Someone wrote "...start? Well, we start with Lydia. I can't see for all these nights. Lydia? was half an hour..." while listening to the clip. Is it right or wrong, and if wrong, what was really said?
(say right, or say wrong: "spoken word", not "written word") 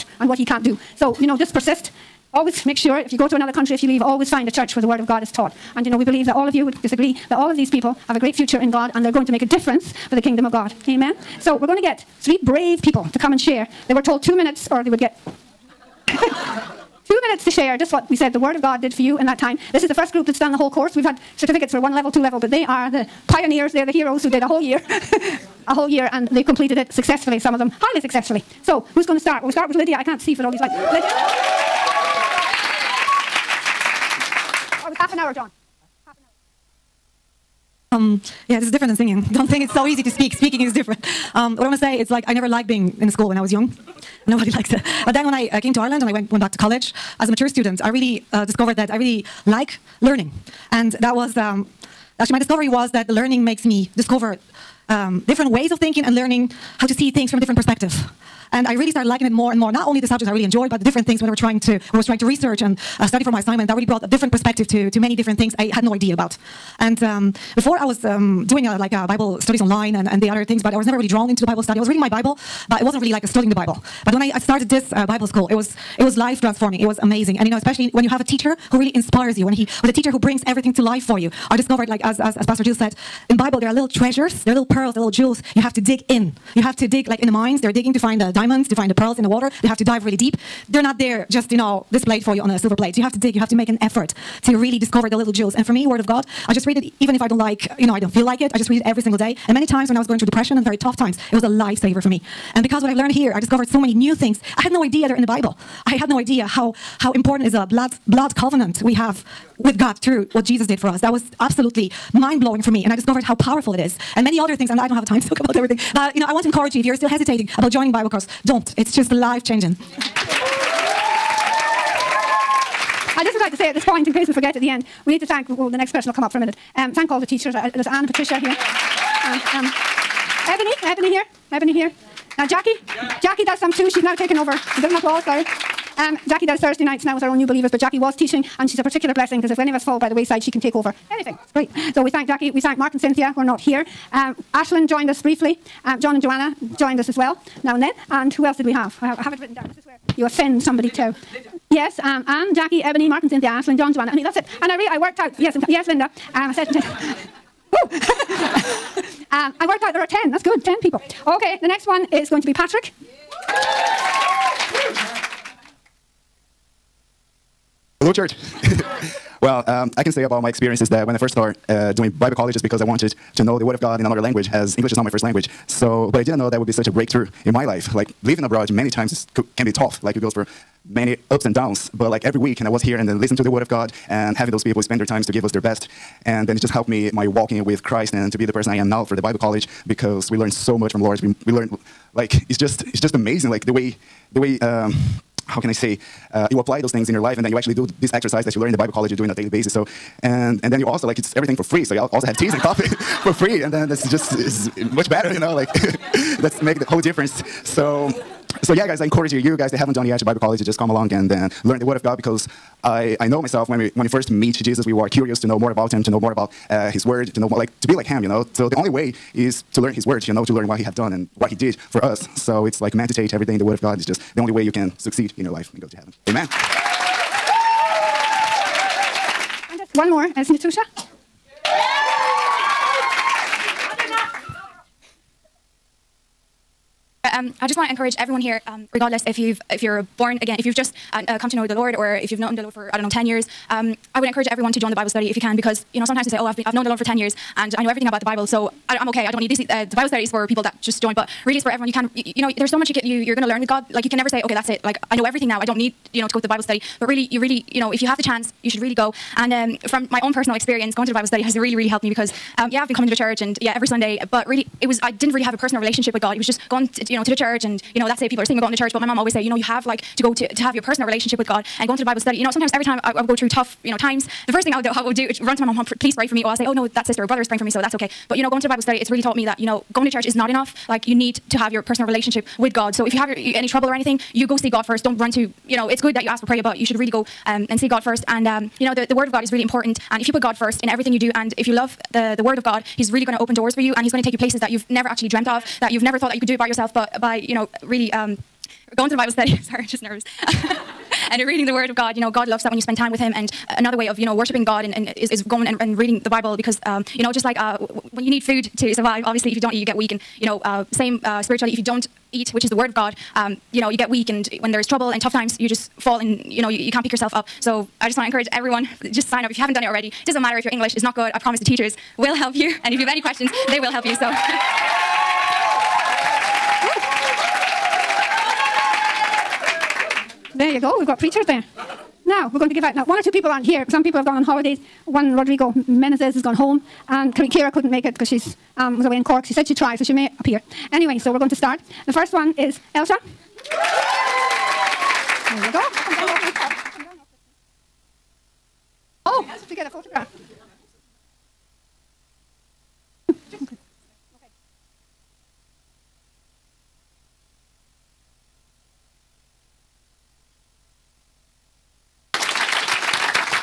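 wrong: "lights", not "nights".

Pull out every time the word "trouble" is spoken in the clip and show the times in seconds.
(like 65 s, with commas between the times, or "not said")
283 s, 314 s.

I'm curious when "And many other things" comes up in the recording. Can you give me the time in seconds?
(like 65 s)
114 s.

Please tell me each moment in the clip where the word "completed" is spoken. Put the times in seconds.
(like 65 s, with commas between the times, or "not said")
26 s.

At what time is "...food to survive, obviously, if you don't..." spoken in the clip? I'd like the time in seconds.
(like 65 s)
308 s.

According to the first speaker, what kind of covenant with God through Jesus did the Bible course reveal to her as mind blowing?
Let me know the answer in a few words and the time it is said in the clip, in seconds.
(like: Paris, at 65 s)
Blood covenant, at 108 s.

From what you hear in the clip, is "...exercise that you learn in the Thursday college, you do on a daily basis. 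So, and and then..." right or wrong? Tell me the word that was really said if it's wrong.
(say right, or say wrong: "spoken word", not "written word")
wrong: "Bible", not "Thursday".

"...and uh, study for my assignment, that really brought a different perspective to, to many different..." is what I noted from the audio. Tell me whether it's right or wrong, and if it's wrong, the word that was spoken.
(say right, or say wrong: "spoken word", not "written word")
right.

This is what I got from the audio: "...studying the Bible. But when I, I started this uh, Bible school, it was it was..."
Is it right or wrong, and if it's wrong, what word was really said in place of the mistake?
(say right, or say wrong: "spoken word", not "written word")
right.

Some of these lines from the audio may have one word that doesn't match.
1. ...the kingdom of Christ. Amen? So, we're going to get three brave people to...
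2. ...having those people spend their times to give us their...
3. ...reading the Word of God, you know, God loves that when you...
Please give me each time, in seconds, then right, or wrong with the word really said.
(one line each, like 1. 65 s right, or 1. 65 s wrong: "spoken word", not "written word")
1. 10 s wrong: "God", not "Christ"
2. 184 s right
3. 301 s right.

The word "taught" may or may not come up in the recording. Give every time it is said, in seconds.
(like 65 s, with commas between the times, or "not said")
5 s, 279 s.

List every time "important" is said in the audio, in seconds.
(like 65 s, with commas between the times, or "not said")
107 s, 289 s.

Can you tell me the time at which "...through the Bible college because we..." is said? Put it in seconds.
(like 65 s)
189 s.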